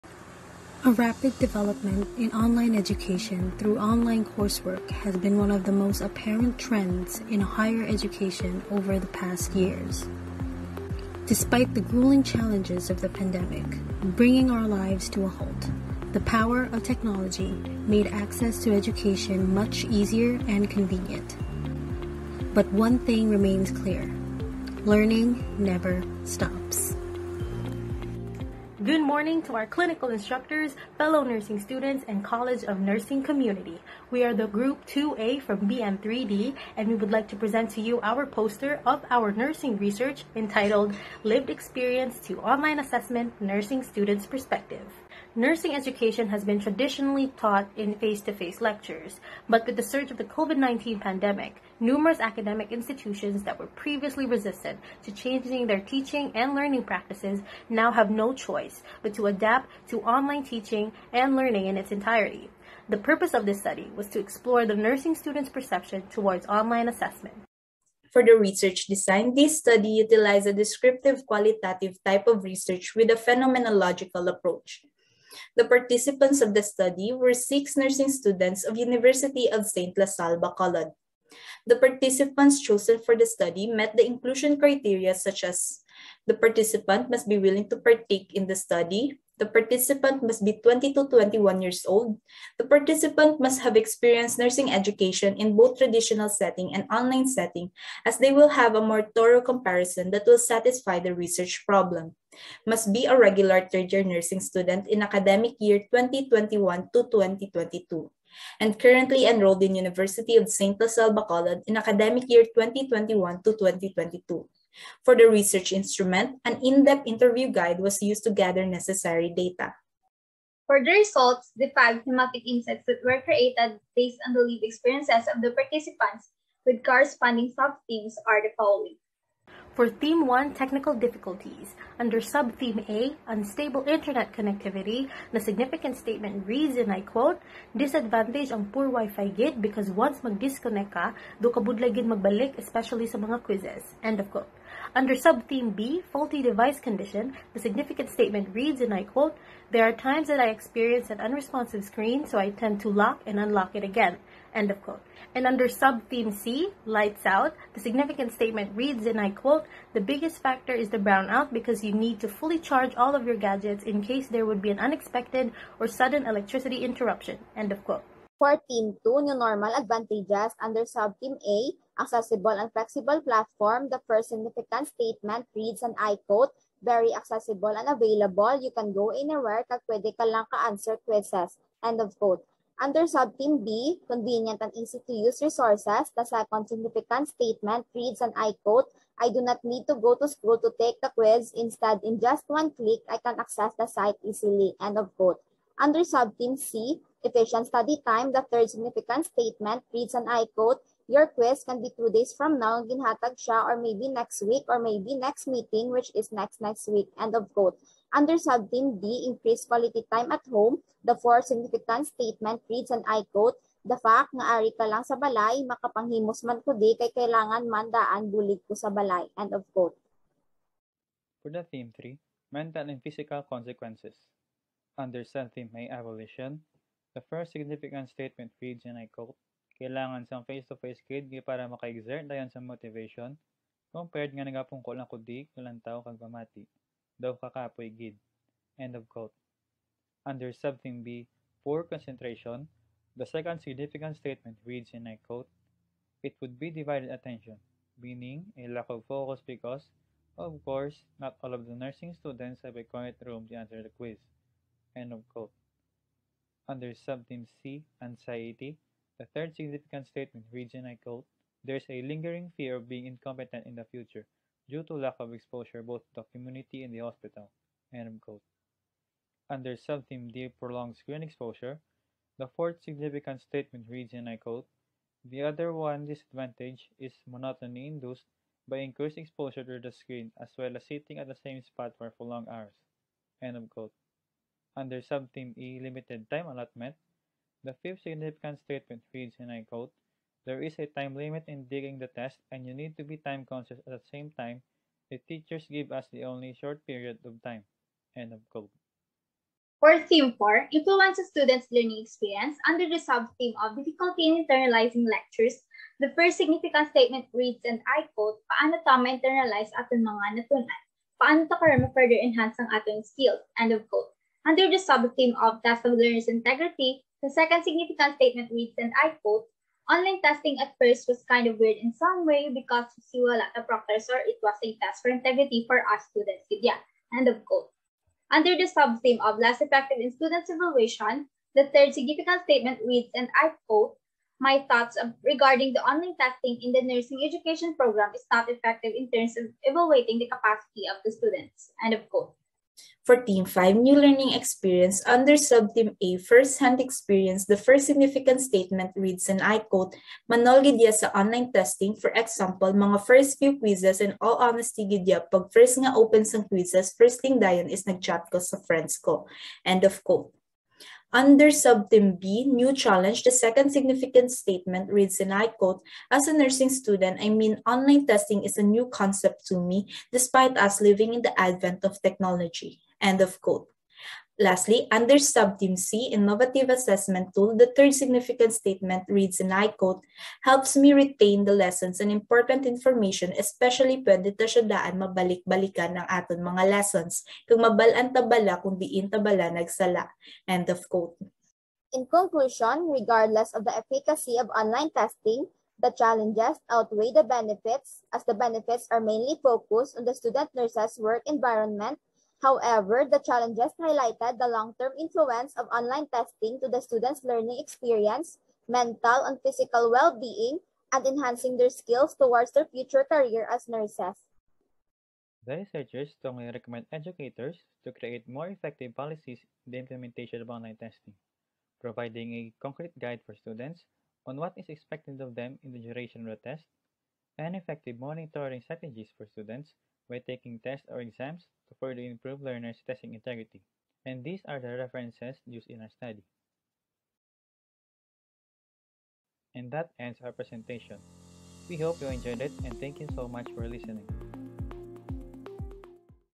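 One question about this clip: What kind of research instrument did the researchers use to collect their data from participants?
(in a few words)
in-depth interview guide.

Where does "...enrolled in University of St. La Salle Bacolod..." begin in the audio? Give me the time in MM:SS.
01:49.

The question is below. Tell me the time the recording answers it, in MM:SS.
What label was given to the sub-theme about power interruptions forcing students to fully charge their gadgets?
02:36.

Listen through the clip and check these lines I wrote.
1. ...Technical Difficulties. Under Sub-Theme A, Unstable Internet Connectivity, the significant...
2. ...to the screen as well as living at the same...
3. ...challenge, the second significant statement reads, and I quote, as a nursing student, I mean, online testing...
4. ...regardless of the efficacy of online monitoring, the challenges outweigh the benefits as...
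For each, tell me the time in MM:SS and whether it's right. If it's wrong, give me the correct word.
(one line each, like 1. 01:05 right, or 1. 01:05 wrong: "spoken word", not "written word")
1. 02:10 right
2. 04:39 wrong: "sitting", not "living"
3. 06:02 right
4. 06:32 wrong: "testing", not "monitoring".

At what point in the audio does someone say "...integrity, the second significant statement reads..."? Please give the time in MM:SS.
05:16.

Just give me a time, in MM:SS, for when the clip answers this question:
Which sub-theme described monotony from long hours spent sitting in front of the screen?
04:30.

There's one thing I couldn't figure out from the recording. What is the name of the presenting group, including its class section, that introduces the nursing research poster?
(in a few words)
Group 2A.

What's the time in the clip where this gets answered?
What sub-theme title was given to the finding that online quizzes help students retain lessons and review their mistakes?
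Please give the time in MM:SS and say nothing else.
06:16.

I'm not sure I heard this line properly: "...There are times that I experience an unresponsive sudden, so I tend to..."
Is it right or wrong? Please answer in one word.
wrong.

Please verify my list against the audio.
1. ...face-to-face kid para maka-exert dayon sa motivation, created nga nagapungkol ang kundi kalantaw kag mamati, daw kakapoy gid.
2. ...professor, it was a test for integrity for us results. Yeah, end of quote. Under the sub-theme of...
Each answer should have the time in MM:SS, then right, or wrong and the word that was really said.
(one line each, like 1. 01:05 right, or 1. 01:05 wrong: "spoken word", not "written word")
1. 03:50 wrong: "compared", not "created"
2. 05:23 wrong: "students", not "results".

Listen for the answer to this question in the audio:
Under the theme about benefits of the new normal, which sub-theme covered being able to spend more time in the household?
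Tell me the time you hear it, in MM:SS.
03:29.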